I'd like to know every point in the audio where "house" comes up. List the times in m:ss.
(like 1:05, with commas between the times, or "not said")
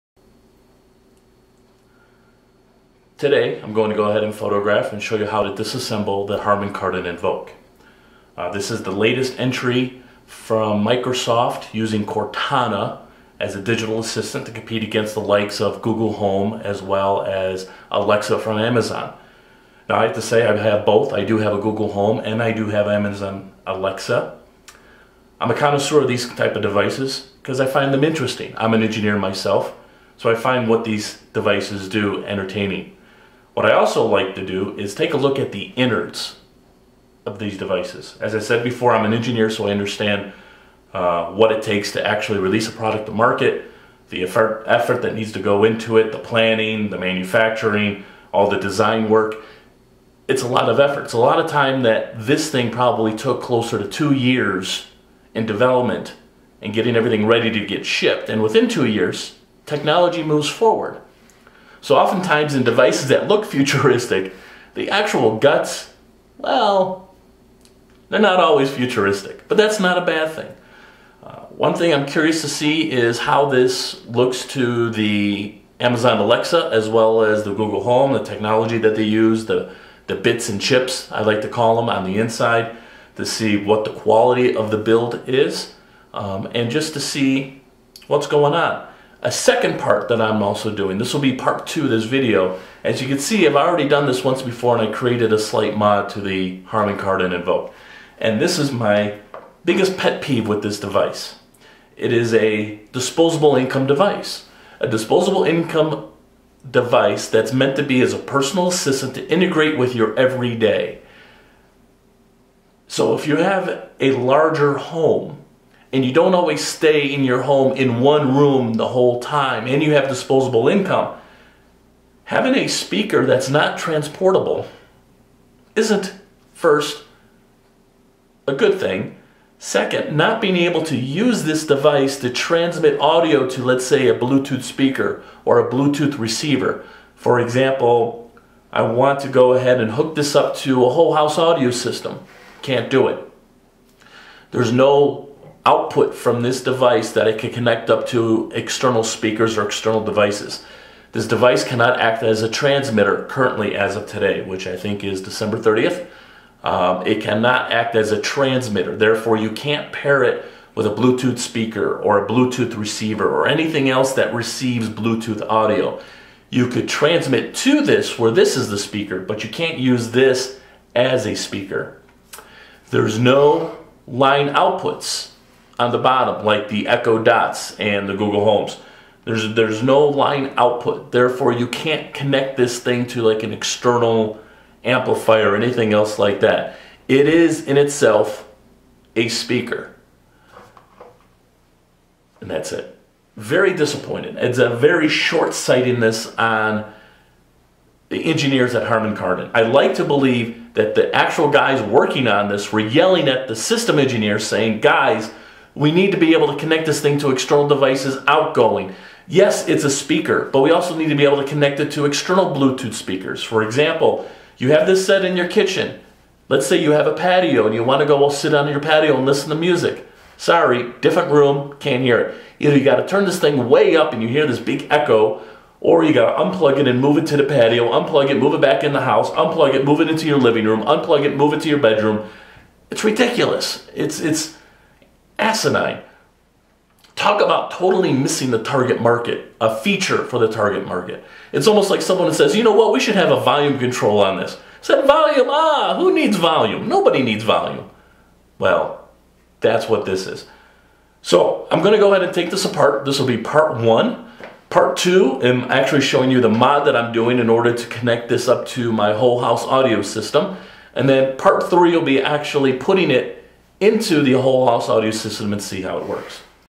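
2:21, 3:49, 4:19, 4:24.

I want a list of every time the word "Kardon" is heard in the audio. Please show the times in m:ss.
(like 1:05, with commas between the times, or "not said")
0:06, 1:36, 3:19.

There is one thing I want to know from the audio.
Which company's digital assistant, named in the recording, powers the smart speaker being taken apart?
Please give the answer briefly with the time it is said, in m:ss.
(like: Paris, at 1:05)
Cortana, at 0:12.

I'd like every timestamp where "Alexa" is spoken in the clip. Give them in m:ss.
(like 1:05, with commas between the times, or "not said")
0:17, 0:23, 1:16.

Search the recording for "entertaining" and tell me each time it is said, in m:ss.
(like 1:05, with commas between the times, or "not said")
0:32.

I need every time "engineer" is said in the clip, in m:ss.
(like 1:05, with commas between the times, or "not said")
0:28, 0:39, 3:18, 3:23.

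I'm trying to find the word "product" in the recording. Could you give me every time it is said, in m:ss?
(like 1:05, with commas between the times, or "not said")
0:42.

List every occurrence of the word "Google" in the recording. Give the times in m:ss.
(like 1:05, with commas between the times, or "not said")
0:15, 0:21, 1:17, 2:58.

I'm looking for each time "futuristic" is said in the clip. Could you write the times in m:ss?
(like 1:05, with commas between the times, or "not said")
1:03, 1:08.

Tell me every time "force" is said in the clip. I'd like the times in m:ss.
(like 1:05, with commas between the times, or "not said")
not said.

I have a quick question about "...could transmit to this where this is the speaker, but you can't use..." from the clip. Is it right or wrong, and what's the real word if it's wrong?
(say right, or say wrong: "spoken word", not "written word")
right.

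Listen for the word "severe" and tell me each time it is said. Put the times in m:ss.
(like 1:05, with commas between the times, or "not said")
not said.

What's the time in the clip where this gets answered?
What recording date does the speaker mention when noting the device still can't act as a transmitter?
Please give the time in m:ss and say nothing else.
2:35.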